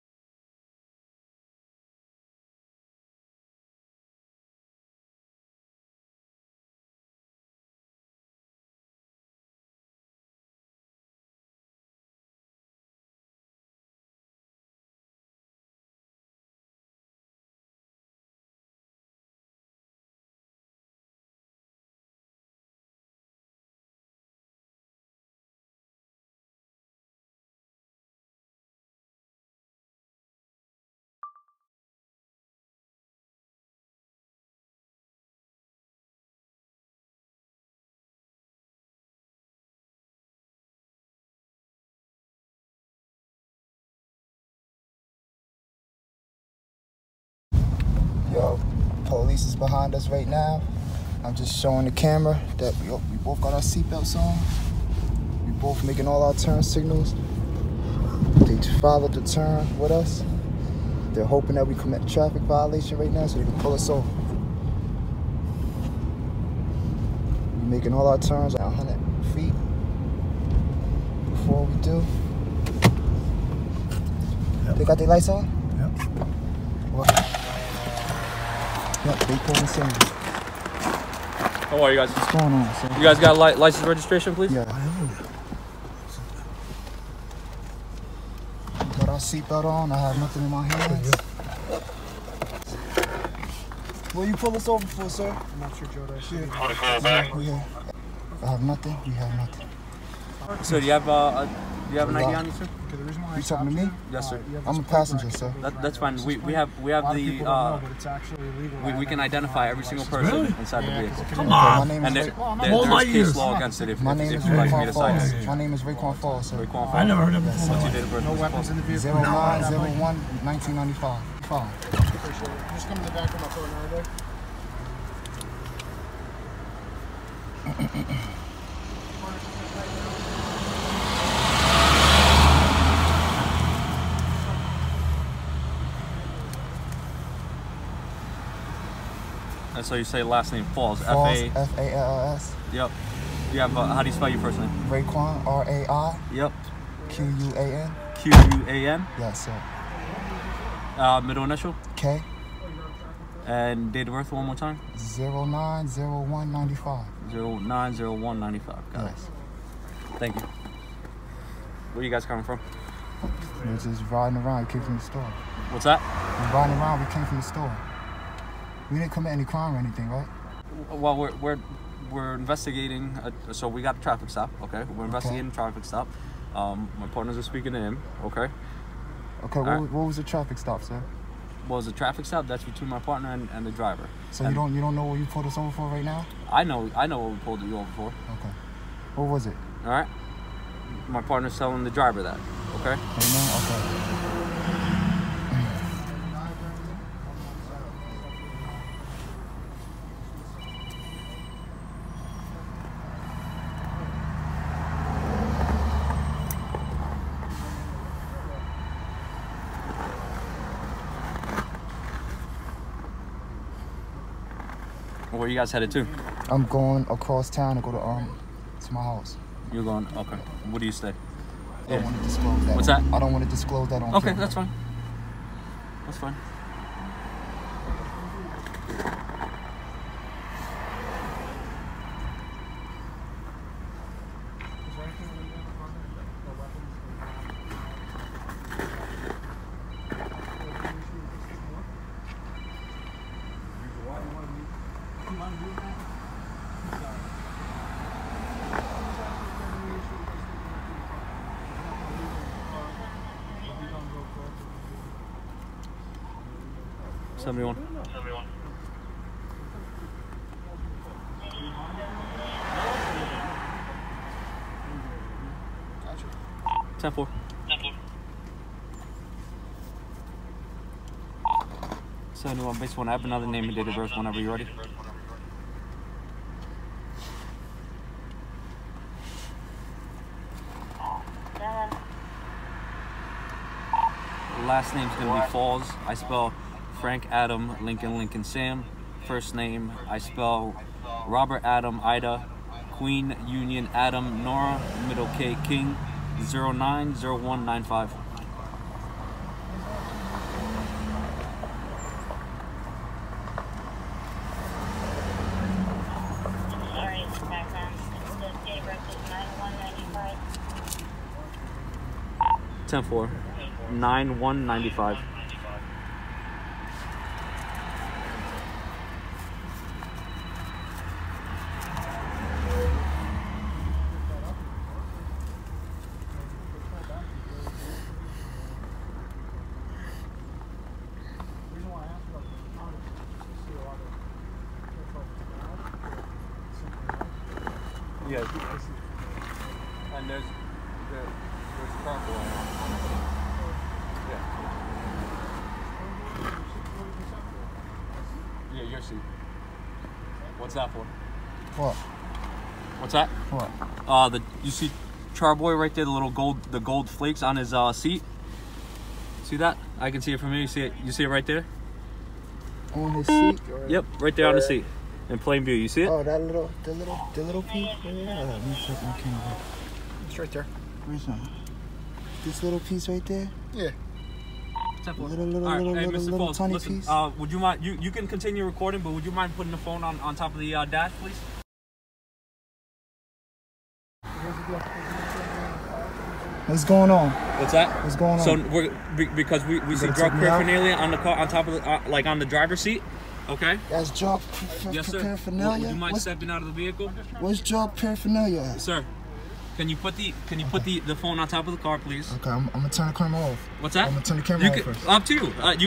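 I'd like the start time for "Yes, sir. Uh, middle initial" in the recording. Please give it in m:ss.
2:29.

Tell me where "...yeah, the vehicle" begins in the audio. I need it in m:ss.
1:50.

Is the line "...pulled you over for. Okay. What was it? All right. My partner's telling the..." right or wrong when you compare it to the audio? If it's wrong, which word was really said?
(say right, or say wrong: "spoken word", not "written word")
right.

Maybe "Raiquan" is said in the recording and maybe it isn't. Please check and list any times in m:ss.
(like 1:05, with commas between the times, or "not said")
1:55, 2:24.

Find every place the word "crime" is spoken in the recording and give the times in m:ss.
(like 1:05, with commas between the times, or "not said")
2:49.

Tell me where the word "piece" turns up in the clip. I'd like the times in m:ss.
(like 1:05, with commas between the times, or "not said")
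6:07, 6:12, 6:16.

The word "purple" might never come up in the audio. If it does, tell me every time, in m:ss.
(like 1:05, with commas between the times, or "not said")
5:42.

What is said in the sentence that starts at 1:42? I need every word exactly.
Okay, the reason why you talking to me?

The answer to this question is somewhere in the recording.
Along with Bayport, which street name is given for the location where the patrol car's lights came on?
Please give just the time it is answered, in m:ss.
1:19.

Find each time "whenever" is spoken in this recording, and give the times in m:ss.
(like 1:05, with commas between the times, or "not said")
4:34.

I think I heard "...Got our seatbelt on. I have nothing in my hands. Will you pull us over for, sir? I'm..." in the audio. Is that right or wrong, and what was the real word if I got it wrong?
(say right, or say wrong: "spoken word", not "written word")
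right.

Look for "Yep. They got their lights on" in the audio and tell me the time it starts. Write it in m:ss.
1:14.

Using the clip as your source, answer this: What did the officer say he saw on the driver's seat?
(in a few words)
gold flakes.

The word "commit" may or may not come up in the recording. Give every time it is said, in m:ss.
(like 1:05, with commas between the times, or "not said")
1:01, 2:49.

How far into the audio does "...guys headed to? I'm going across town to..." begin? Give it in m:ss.
3:35.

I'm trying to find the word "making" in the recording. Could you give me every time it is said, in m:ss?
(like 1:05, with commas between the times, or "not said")
0:55, 1:07.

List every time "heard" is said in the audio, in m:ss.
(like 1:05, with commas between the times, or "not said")
1:57.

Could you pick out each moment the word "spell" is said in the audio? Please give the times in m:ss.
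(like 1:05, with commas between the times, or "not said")
2:24, 4:46, 4:50.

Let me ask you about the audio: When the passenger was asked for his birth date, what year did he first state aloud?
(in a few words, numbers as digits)
1995.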